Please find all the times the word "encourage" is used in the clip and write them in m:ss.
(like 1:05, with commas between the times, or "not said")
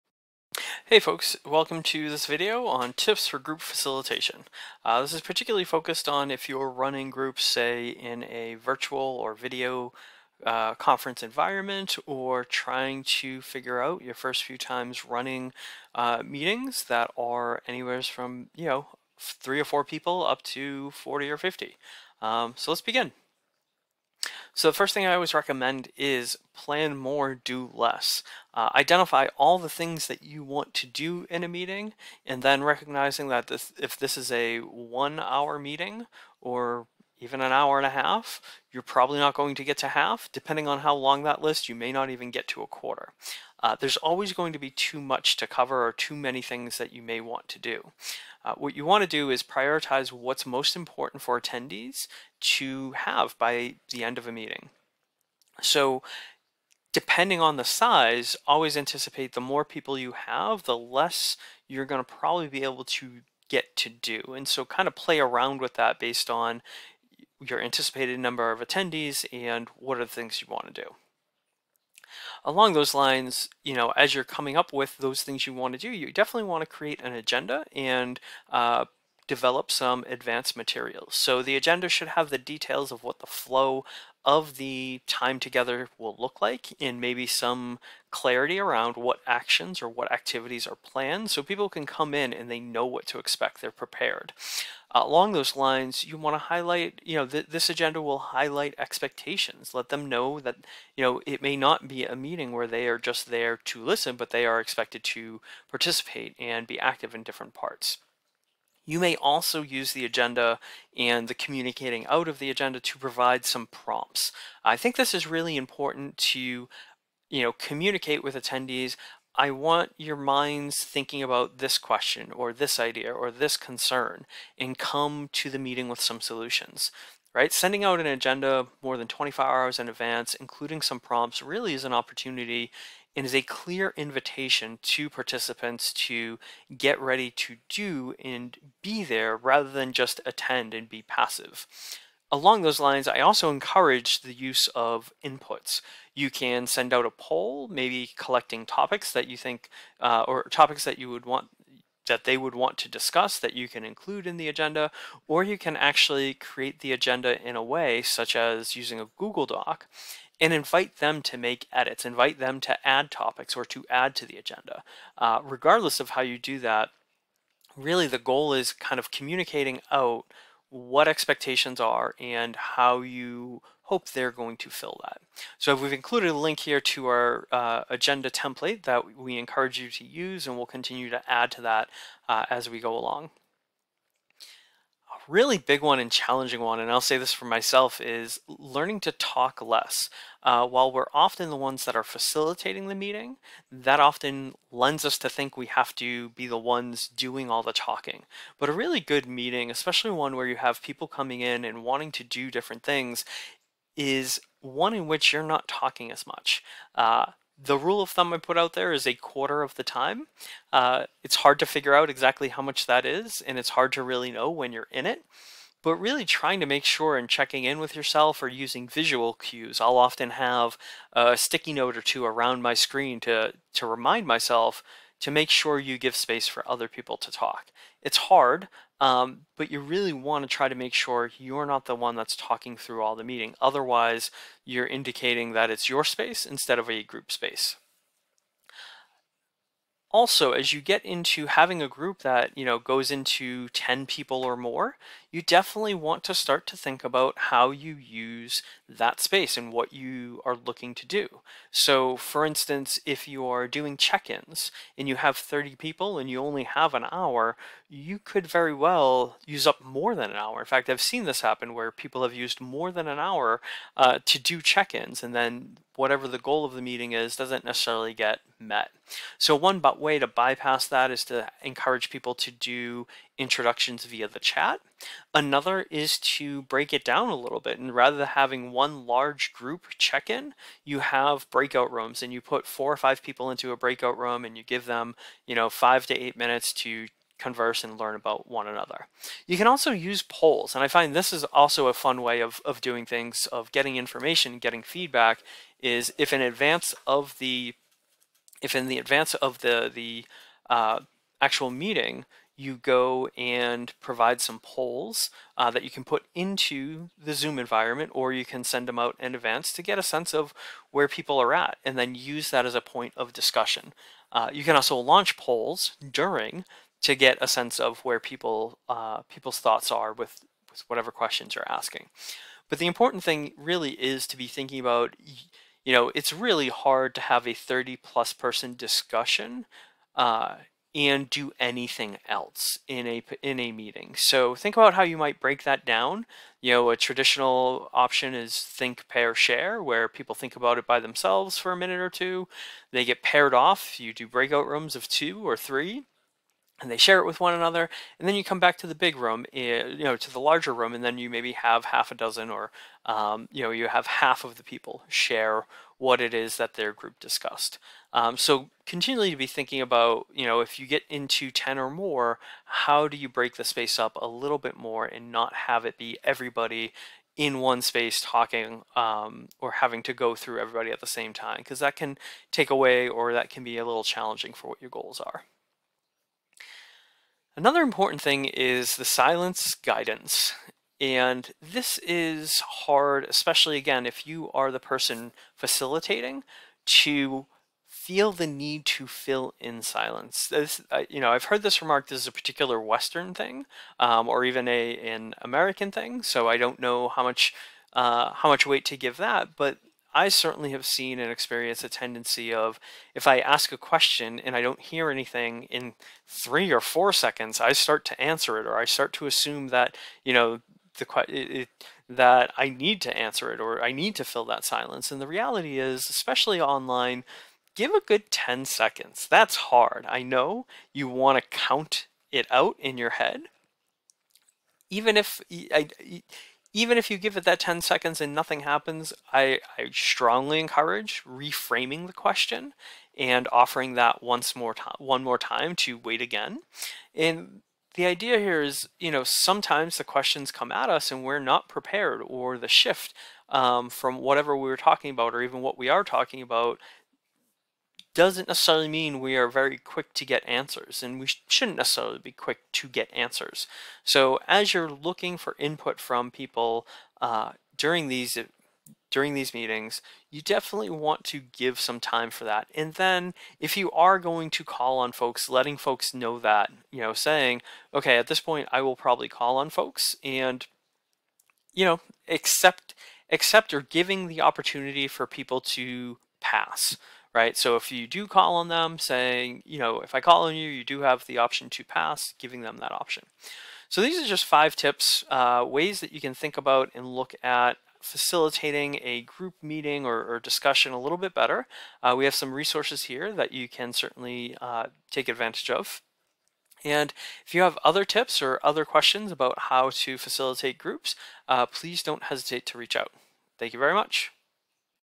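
2:23, 2:59, 4:31, 7:10.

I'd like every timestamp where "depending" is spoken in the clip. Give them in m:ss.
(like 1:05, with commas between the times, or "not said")
0:40, 0:56.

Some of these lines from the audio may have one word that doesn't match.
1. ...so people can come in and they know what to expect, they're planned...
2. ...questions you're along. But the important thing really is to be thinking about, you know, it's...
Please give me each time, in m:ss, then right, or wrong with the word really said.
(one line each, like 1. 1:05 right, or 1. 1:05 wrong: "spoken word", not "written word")
1. 1:31 wrong: "prepared", not "planned"
2. 5:21 wrong: "asking", not "along".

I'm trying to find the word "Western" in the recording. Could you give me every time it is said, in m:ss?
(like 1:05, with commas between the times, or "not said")
6:32.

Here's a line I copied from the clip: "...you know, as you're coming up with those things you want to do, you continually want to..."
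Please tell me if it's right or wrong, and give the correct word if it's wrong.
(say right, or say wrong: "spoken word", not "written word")
wrong: "definitely", not "continually".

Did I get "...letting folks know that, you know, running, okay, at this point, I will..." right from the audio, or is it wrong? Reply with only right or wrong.
wrong.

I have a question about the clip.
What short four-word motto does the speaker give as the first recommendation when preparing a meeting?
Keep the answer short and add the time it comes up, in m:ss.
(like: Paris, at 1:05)
plan more, do less, at 0:26.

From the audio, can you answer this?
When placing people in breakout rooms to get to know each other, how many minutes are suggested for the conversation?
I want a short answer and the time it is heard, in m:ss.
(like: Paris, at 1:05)
5 to 8 minutes, at 4:45.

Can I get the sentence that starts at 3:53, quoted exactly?
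Otherwise, you're indicating that it's your space instead of a group space.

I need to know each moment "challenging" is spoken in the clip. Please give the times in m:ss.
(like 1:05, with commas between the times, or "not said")
3:06, 6:14.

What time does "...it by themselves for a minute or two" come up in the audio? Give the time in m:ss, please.
5:40.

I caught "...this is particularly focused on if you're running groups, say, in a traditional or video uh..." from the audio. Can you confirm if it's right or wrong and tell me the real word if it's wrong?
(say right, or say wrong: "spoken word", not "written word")
wrong: "virtual", not "traditional".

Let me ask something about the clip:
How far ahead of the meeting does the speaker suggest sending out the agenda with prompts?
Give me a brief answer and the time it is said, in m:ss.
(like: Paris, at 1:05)
more than 24 hours, at 2:08.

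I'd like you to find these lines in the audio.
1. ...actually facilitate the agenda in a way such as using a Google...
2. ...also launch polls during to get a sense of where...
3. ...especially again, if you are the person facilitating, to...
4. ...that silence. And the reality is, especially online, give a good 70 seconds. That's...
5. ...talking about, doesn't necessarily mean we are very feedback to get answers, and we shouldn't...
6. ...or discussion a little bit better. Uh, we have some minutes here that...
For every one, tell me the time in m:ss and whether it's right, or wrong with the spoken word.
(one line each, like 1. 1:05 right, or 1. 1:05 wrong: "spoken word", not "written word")
1. 2:35 wrong: "create", not "facilitate"
2. 5:14 right
3. 6:23 right
4. 6:54 wrong: "10", not "70"
5. 7:26 wrong: "quick", not "feedback"
6. 8:10 wrong: "resources", not "minutes".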